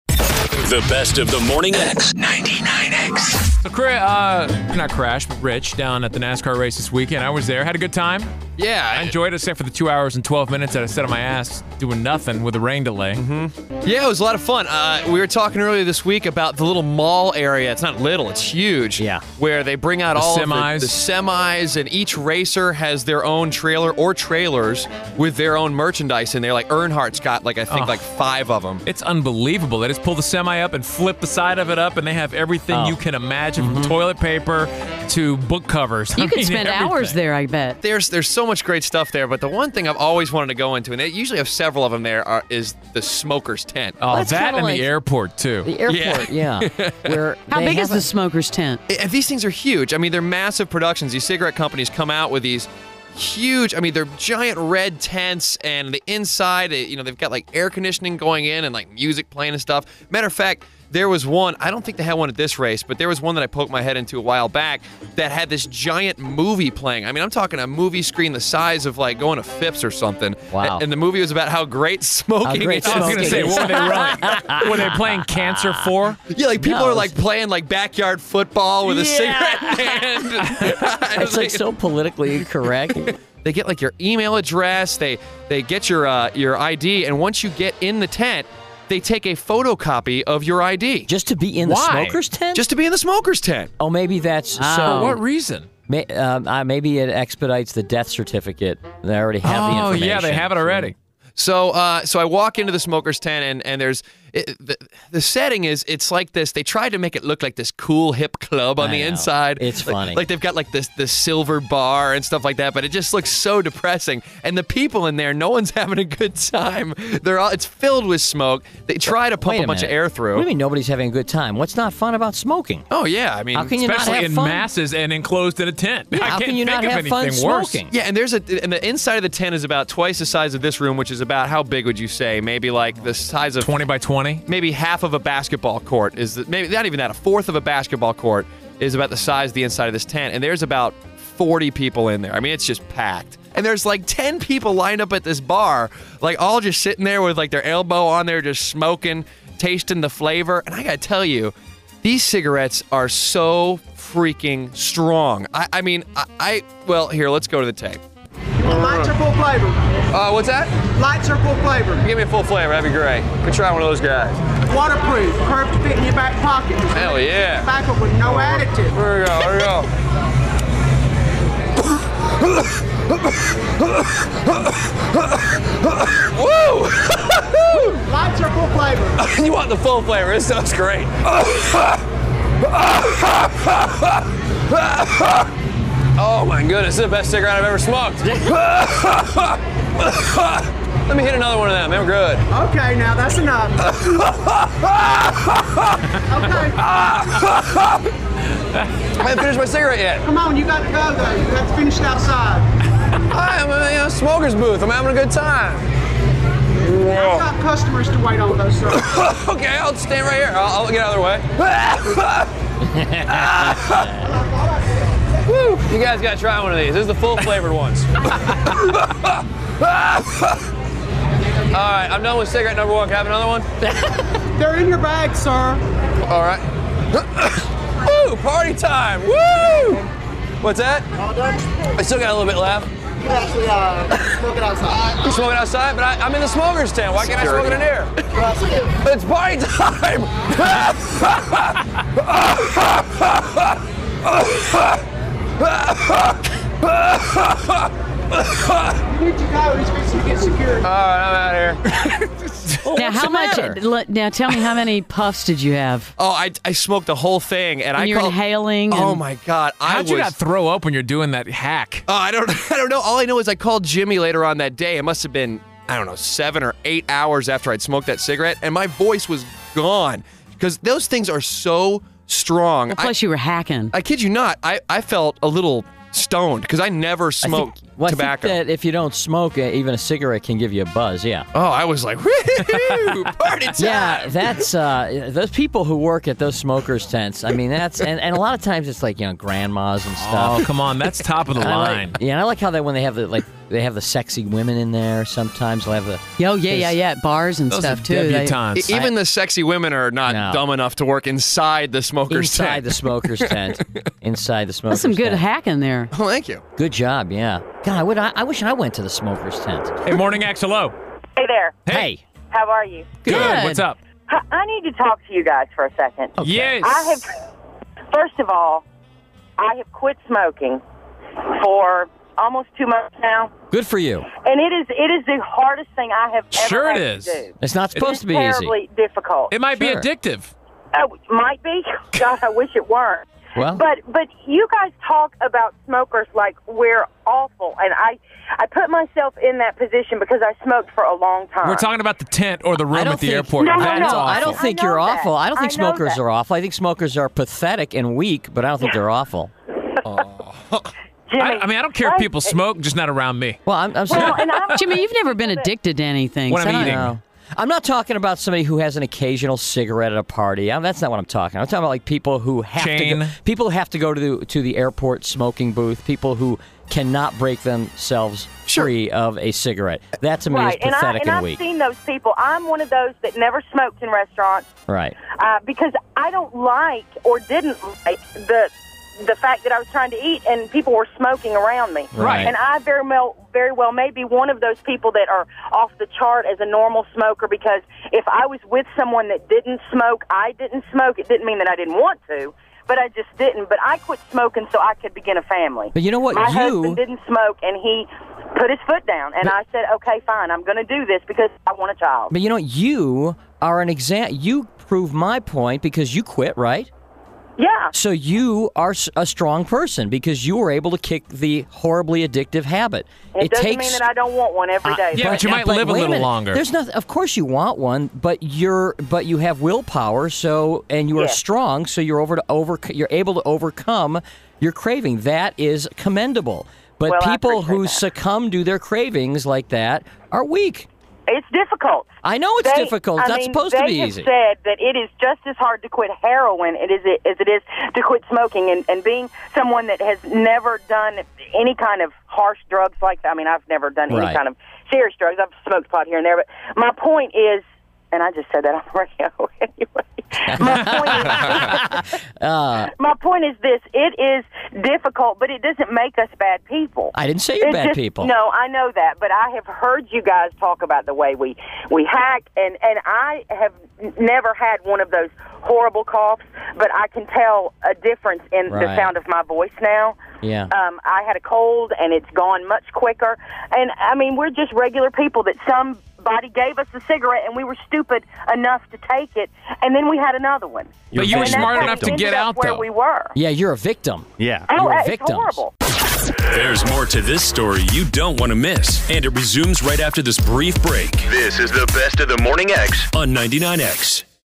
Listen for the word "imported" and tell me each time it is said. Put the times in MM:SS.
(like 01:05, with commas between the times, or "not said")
not said.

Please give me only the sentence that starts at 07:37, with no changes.
I didn't say you're it's bad just, people.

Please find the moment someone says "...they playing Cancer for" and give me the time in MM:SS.
01:14.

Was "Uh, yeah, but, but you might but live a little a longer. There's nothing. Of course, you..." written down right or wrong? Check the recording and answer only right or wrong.
right.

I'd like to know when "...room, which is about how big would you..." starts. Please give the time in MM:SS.
02:10.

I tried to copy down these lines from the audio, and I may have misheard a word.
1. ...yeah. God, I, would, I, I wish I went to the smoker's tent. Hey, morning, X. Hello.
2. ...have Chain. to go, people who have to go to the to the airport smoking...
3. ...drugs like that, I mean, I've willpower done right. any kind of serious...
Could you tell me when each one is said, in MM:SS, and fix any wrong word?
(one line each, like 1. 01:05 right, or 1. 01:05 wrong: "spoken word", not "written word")
1. 05:07 right
2. 06:02 right
3. 07:22 wrong: "never", not "willpower".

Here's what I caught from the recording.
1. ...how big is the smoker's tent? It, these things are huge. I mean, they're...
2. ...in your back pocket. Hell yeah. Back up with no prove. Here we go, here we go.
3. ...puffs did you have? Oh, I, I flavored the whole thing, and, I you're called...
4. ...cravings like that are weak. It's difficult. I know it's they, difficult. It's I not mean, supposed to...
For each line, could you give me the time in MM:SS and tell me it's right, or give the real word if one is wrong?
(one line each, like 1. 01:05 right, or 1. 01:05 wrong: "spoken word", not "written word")
1. 00:47 right
2. 02:45 wrong: "additive", not "prove"
3. 04:15 wrong: "smoked", not "flavored"
4. 07:08 right.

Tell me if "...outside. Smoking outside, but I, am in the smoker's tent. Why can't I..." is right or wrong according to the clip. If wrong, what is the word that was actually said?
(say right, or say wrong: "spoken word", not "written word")
right.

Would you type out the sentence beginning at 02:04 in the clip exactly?
masses and enclosed in a tent.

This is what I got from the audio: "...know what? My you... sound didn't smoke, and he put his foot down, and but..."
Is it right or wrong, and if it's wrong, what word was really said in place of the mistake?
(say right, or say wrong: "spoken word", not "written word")
wrong: "husband", not "sound".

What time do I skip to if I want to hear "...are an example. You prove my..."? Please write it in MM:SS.
06:43.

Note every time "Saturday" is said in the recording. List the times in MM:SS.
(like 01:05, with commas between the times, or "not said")
not said.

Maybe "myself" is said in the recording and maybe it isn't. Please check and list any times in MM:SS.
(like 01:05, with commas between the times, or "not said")
05:38.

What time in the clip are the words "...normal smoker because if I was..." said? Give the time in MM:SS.
06:26.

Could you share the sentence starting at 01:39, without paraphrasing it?
They already have oh, the information.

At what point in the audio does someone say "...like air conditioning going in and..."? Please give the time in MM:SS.
00:57.